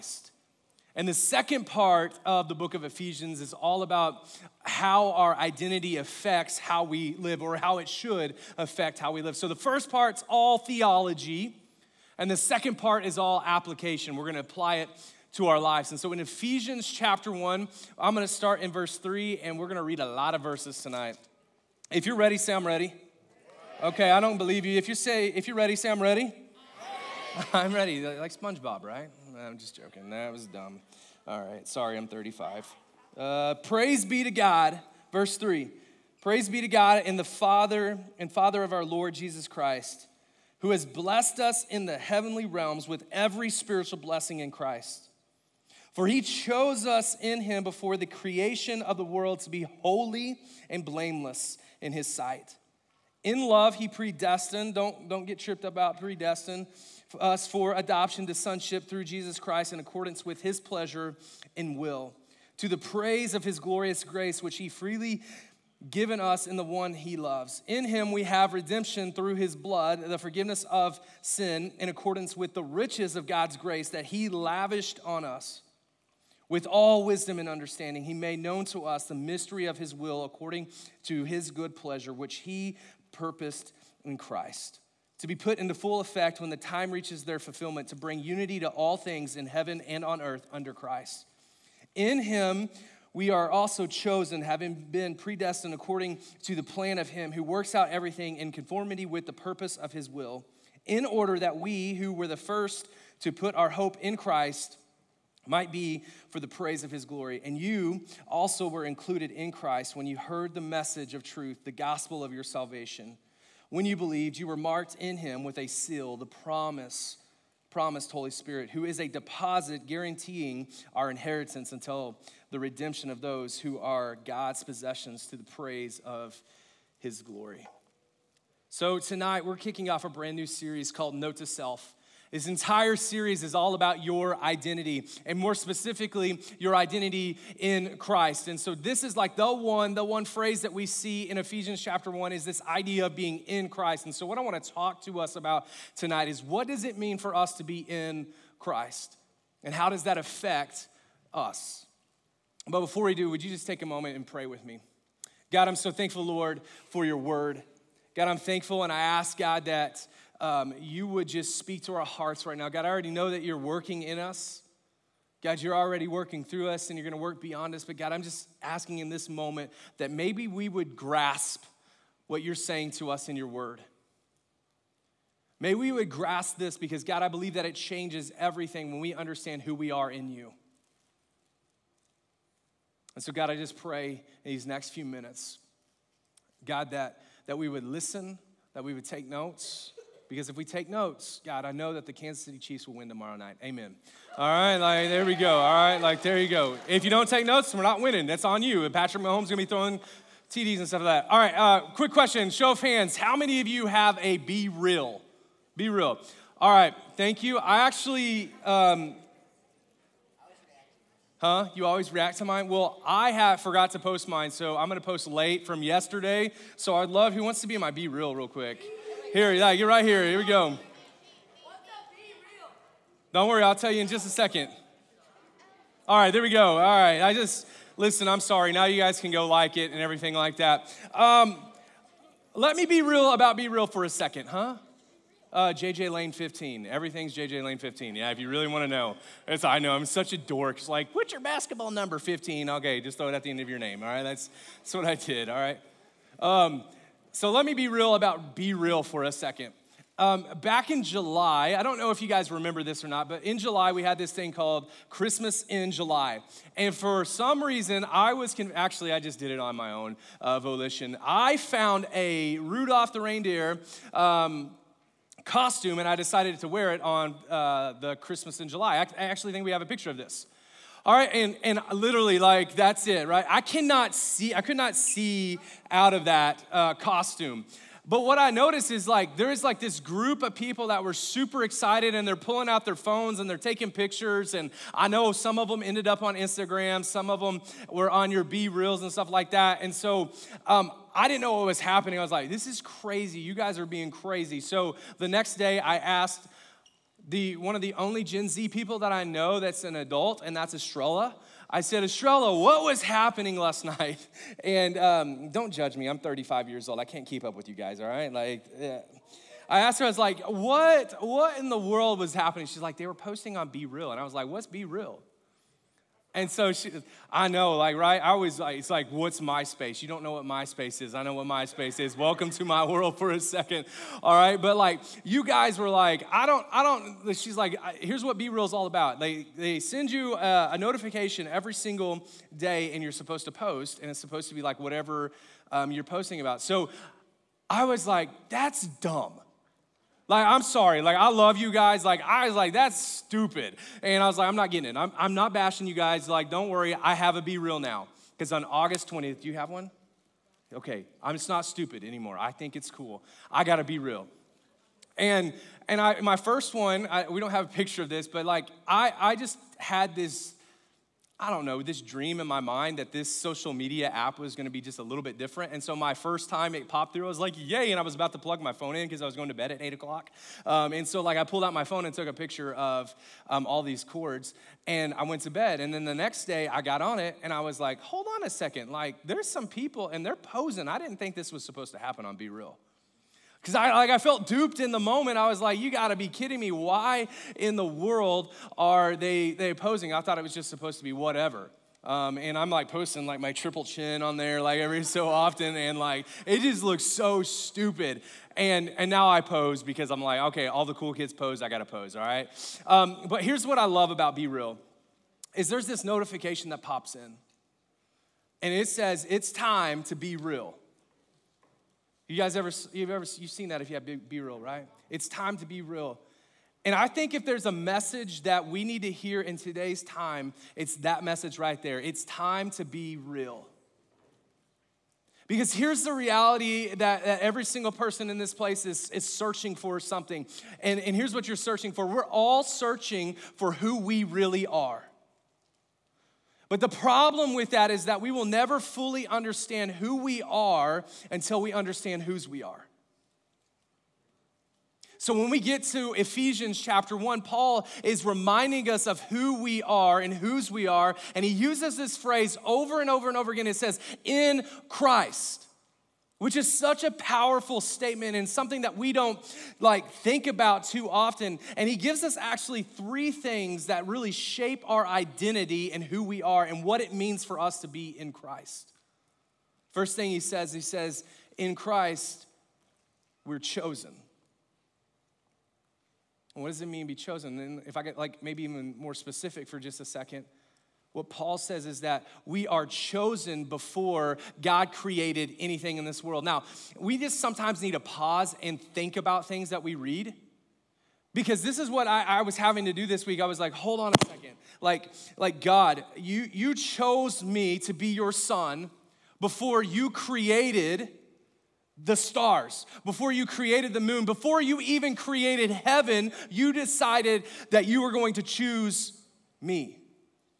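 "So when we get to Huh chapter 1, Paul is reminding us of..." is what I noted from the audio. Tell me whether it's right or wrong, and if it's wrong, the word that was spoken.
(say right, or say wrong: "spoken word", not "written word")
wrong: "Ephesians", not "Huh".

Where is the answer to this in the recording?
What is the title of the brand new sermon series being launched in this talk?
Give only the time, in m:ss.
2:11.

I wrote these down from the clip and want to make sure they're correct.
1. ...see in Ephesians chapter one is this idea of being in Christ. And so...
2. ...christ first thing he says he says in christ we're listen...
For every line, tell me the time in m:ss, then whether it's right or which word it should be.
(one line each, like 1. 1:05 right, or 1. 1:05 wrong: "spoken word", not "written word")
1. 2:20 right
2. 7:48 wrong: "chosen", not "listen".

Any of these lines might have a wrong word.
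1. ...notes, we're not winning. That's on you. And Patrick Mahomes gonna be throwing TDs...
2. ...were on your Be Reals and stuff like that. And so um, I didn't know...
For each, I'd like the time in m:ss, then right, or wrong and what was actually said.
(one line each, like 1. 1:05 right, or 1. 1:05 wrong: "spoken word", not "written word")
1. 3:17 right
2. 4:47 right.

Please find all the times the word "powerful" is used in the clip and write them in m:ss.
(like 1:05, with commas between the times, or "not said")
7:37.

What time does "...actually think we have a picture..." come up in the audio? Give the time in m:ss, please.
4:29.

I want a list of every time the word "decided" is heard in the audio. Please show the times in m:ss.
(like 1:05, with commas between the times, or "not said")
4:26, 8:26.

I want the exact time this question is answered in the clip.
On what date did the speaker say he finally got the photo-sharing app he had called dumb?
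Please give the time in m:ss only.
5:48.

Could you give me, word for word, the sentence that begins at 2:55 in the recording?
May we would grasp this because, God, I believe that it changes everything when we understand who we are in you.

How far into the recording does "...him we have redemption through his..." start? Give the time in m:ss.
1:07.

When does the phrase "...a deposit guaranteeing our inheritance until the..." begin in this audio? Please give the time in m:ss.
1:59.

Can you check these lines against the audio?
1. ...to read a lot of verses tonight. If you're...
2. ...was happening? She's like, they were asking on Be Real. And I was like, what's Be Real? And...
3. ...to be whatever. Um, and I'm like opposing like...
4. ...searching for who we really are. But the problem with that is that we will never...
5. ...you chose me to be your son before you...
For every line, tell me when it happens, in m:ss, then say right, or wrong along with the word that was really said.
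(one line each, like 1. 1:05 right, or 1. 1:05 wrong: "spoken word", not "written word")
1. 0:19 right
2. 5:12 wrong: "posting", not "asking"
3. 6:30 wrong: "posting", not "opposing"
4. 7:12 right
5. 8:16 right.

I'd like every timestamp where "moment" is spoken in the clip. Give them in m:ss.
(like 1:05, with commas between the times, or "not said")
2:33, 2:49, 6:24.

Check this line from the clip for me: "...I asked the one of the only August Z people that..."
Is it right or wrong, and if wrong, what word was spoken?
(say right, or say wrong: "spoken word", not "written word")
wrong: "Gen", not "August".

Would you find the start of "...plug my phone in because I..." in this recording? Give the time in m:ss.
6:08.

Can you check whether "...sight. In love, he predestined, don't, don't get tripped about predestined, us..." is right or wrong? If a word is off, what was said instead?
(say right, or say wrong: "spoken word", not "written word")
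right.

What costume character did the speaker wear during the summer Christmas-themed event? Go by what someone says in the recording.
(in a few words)
Rudolph the Reindeer.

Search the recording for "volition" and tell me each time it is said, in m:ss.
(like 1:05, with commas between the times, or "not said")
4:20.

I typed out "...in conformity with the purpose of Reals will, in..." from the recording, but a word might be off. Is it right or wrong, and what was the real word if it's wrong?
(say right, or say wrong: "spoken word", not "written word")
wrong: "His", not "Reals".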